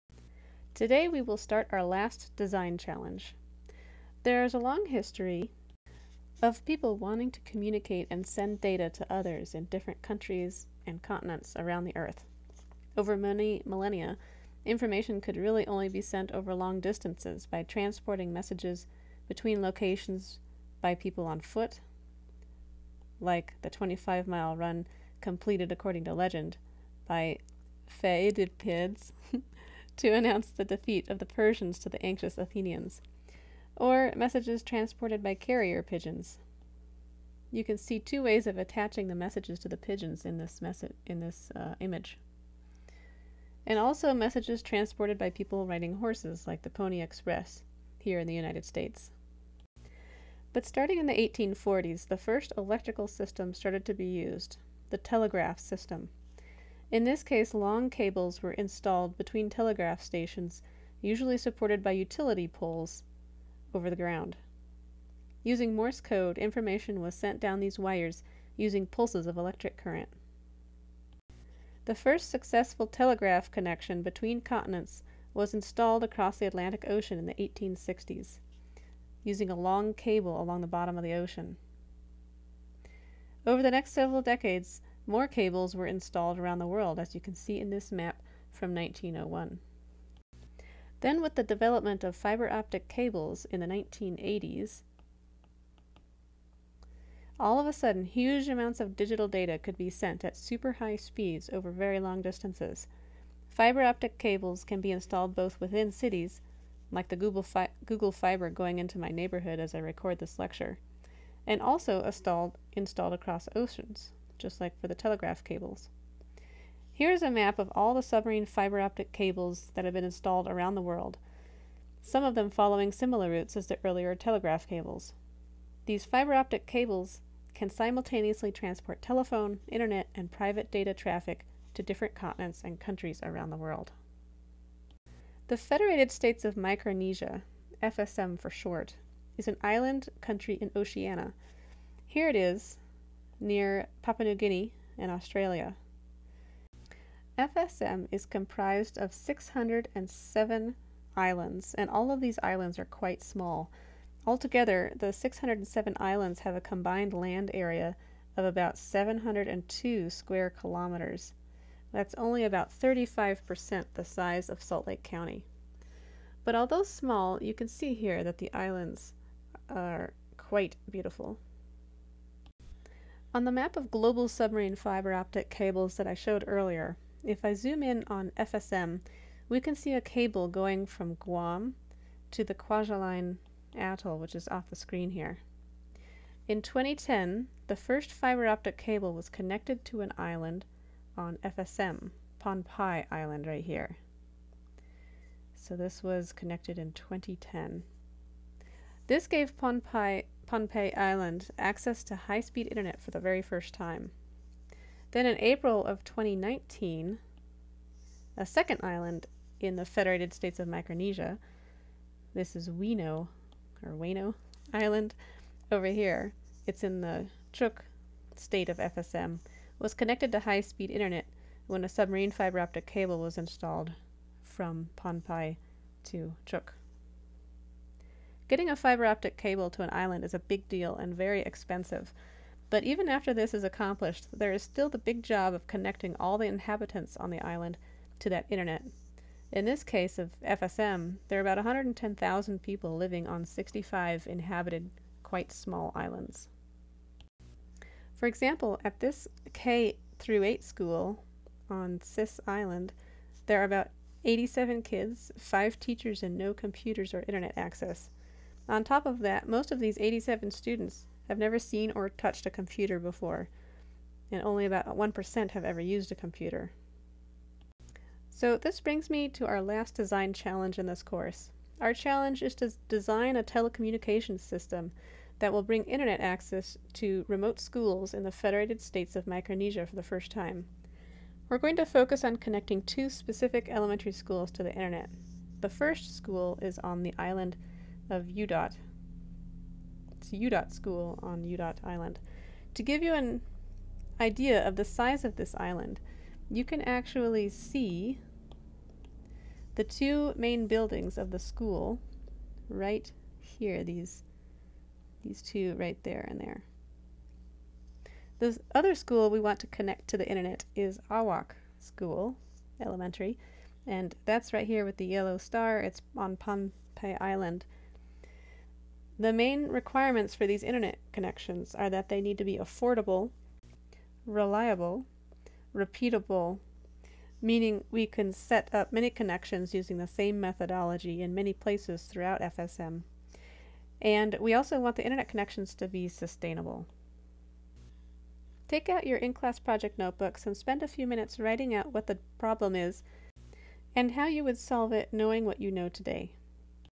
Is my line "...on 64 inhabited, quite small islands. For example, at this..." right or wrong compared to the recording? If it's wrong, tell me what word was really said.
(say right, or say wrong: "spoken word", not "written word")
wrong: "65", not "64".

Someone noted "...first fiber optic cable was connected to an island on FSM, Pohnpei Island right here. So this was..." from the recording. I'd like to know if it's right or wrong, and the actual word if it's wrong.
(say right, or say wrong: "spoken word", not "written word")
right.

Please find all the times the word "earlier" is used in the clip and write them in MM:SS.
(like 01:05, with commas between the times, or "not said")
02:03, 02:56.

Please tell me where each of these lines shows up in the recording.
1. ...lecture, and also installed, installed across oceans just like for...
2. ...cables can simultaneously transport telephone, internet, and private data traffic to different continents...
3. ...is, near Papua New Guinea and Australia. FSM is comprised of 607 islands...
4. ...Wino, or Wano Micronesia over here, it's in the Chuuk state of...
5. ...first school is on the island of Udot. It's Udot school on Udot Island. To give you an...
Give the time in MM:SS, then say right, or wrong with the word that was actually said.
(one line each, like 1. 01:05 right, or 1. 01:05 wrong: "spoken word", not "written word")
1. 01:50 right
2. 02:06 right
3. 02:22 right
4. 03:32 wrong: "Island", not "Micronesia"
5. 04:45 right.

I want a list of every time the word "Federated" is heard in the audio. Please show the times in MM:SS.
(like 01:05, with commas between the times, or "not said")
02:15, 03:29, 04:38.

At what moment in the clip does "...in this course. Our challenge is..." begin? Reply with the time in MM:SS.
04:30.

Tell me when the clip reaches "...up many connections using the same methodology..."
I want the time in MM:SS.
05:28.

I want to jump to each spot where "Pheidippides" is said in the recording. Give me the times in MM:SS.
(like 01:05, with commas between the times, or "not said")
00:27.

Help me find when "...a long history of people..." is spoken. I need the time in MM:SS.
00:04.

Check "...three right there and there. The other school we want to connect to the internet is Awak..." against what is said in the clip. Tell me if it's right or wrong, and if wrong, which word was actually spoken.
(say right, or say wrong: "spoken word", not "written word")
wrong: "two", not "three".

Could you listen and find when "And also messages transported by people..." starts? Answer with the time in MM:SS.
00:43.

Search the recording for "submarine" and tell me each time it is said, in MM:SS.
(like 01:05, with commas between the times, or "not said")
01:58, 02:54, 03:41.